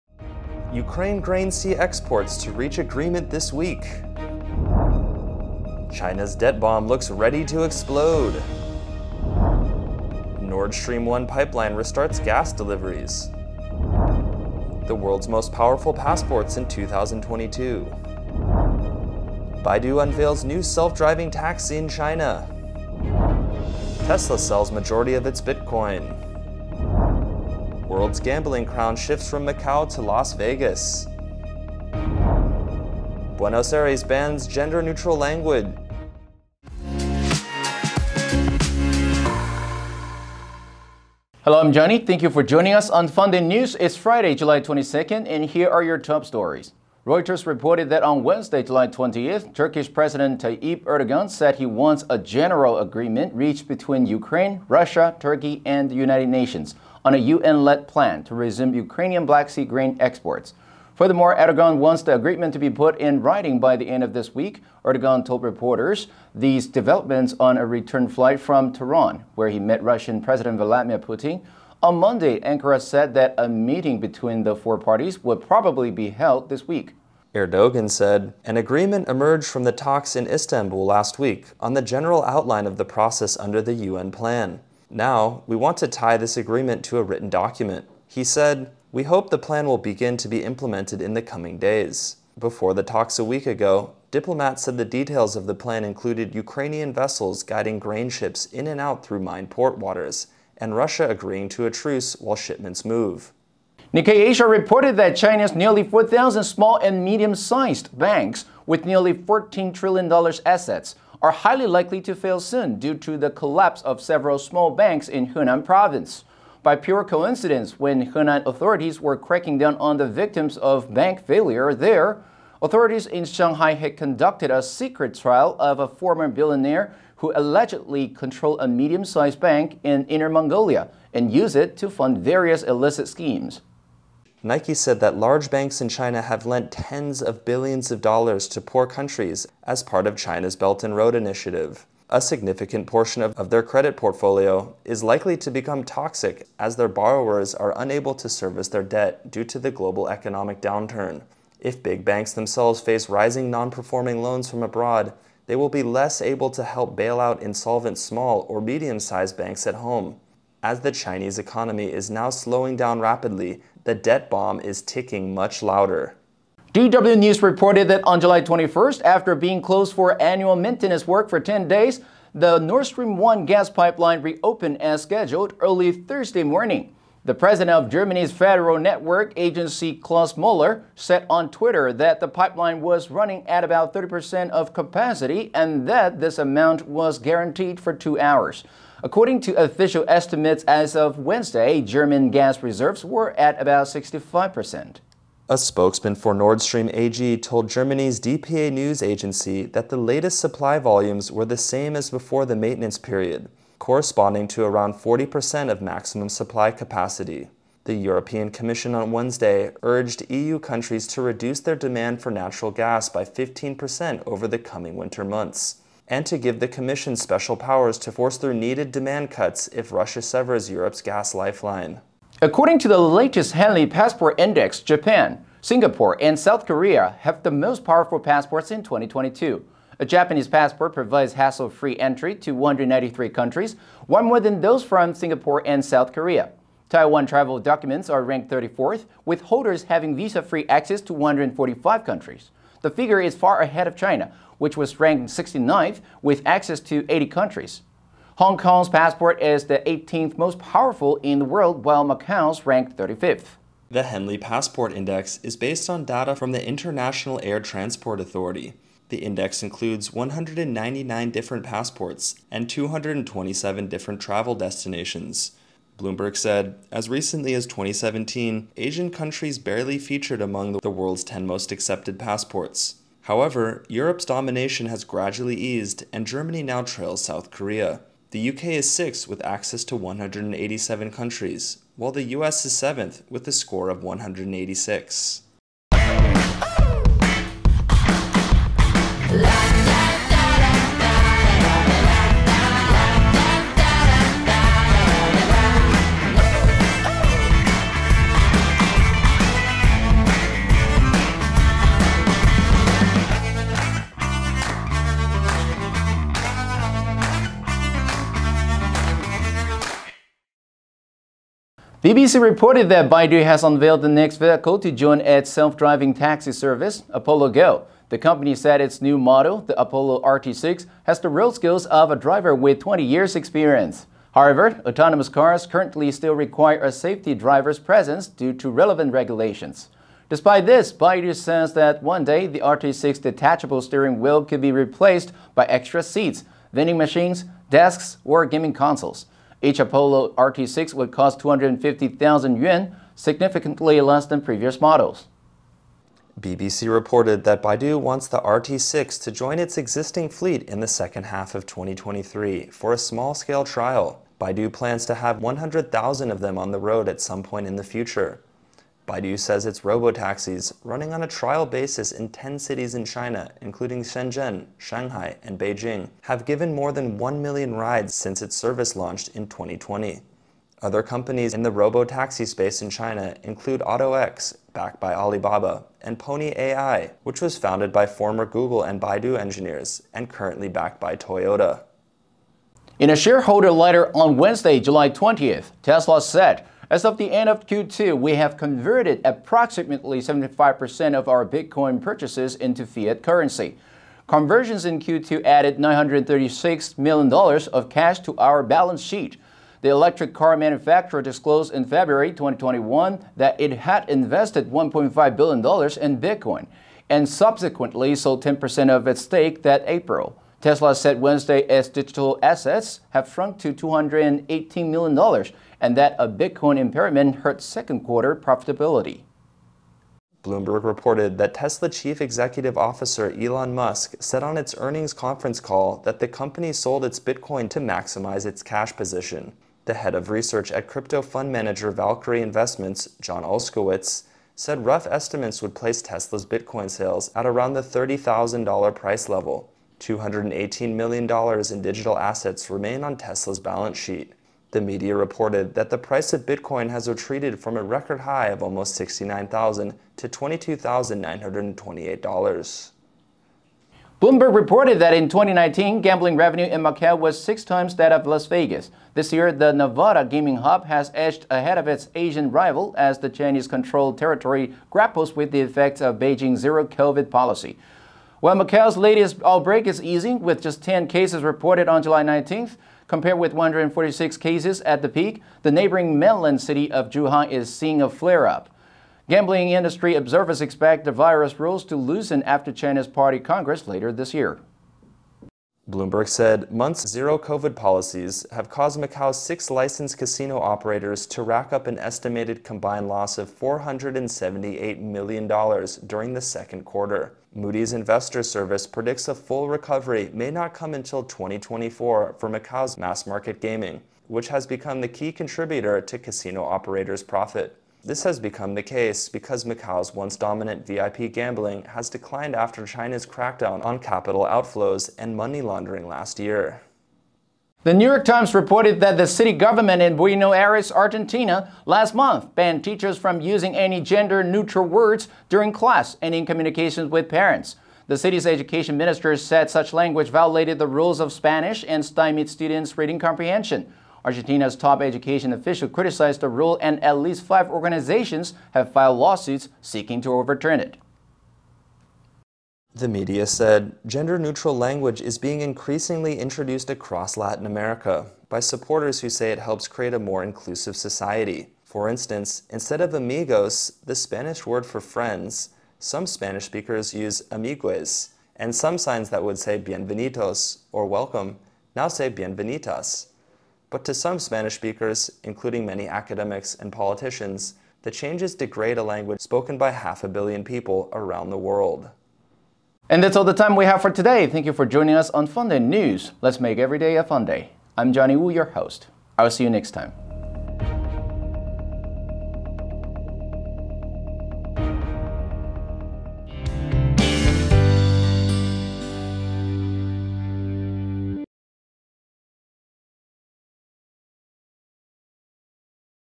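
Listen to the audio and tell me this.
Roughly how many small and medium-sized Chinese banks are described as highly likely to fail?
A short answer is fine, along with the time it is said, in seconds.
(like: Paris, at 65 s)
4,000, at 105 s.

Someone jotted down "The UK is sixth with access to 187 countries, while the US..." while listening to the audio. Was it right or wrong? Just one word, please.
right.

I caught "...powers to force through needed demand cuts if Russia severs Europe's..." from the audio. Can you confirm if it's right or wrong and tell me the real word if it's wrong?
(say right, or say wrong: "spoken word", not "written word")
right.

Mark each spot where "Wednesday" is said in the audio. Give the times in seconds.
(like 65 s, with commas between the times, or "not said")
48 s, 191 s, 209 s, 384 s, 411 s.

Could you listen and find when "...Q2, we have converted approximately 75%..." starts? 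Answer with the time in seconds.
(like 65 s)
387 s.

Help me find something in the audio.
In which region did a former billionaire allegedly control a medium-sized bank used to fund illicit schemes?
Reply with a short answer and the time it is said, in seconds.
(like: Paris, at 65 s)
Inner Mongolia, at 130 s.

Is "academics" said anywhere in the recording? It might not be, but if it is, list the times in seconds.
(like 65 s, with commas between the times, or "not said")
566 s.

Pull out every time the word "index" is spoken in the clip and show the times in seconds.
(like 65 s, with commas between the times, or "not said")
224 s, 254 s, 259 s.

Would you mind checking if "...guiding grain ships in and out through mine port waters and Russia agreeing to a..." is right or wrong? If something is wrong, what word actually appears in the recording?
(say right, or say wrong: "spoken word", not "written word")
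right.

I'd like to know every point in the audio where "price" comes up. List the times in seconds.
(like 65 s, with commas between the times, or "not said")
438 s, 445 s.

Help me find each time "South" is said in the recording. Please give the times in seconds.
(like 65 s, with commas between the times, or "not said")
226 s, 235 s, 277 s.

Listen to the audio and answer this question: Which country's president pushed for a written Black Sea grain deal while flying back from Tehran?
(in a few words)
Turkish.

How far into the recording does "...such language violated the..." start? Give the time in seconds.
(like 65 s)
529 s.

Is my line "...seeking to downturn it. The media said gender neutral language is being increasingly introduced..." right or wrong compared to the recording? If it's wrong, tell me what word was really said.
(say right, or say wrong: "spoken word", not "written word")
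wrong: "overturn", not "downturn".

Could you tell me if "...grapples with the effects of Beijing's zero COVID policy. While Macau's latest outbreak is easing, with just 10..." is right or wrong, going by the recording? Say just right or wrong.
right.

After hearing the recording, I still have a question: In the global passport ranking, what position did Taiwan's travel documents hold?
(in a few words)
34th.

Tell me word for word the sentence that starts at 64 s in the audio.
Erdogan told reporters these developments on a return flight from Tehran, where he met Russian President Vladimir Putin.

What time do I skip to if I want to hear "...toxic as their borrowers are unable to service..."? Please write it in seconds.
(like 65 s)
145 s.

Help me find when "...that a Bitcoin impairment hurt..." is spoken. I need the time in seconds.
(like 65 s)
415 s.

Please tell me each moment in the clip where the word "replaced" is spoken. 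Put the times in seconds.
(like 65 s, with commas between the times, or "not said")
334 s.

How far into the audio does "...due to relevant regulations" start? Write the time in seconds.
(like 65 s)
328 s.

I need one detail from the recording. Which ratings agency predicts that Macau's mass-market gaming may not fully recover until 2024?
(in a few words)
Moody's.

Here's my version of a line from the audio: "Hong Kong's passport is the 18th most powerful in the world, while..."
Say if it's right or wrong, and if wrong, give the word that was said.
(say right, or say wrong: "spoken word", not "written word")
right.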